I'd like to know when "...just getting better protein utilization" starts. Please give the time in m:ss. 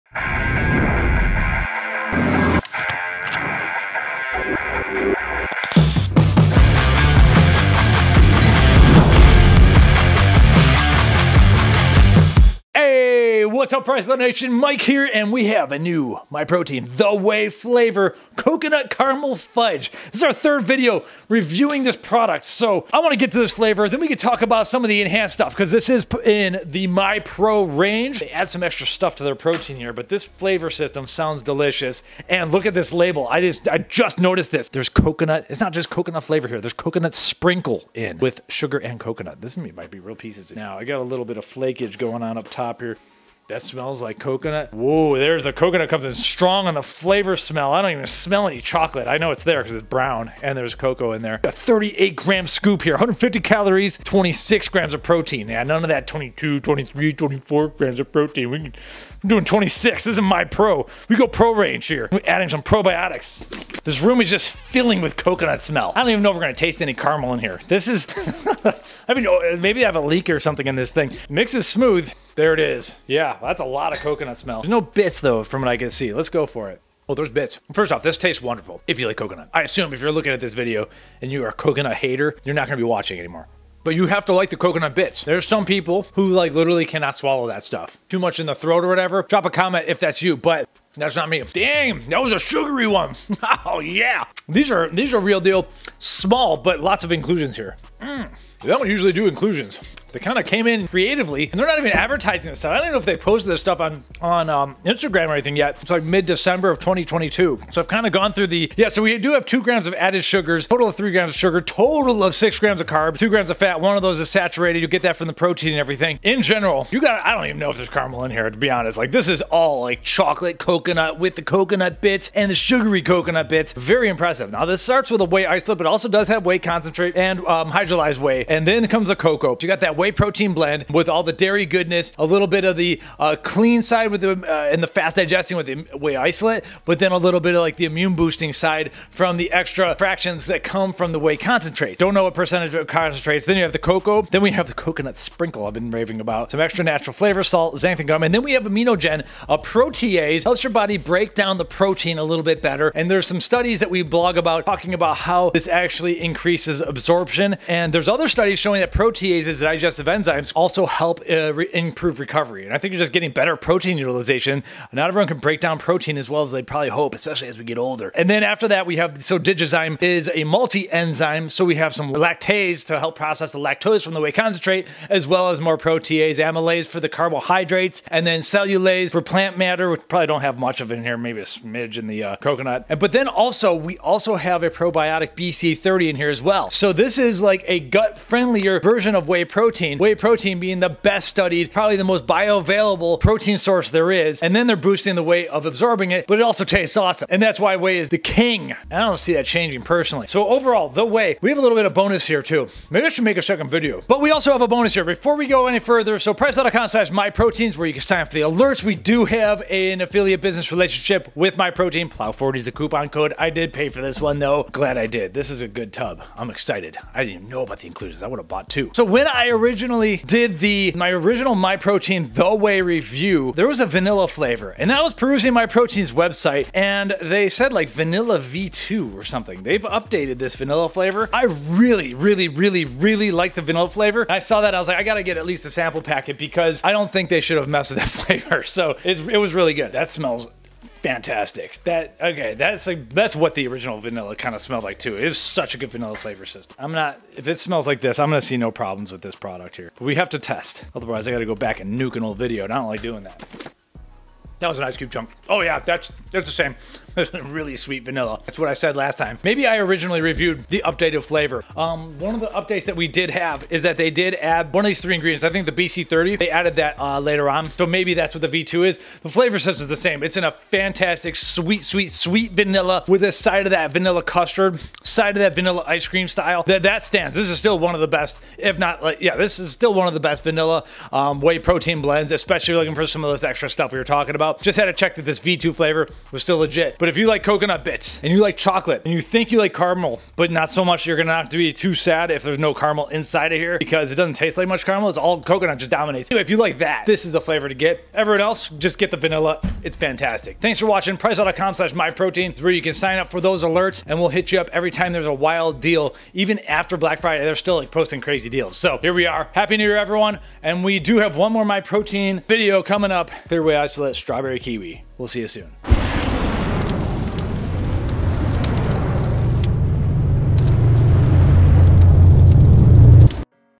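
2:42.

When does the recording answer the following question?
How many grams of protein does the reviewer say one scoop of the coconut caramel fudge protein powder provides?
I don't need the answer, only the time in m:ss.
0:54.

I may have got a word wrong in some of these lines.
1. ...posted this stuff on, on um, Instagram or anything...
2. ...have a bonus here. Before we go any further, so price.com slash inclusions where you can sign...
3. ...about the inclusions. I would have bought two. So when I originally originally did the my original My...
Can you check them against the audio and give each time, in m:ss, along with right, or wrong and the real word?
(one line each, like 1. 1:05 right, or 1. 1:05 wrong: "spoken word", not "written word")
1. 1:43 right
2. 3:24 wrong: "myproteins", not "inclusions"
3. 3:37 right.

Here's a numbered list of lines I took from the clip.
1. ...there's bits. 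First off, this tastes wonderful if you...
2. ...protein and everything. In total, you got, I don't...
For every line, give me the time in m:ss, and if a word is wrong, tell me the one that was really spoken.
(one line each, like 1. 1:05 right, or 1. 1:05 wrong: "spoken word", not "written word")
1. 1:17 right
2. 1:55 wrong: "general", not "total".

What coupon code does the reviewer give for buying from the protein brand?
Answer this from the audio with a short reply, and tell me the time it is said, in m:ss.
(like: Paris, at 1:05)
Plow40, at 3:32.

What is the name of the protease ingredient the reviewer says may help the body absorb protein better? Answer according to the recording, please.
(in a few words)
Aminogen.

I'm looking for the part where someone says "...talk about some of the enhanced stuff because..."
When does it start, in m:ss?
0:24.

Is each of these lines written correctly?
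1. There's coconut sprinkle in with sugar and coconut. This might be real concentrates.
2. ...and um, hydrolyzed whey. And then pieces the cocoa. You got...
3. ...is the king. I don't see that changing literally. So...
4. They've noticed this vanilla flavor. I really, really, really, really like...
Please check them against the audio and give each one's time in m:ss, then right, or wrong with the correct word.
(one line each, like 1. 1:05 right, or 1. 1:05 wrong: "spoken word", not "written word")
1. 0:36 wrong: "pieces", not "concentrates"
2. 2:07 wrong: "comes", not "pieces"
3. 3:17 wrong: "personally", not "literally"
4. 3:49 wrong: "updated", not "noticed".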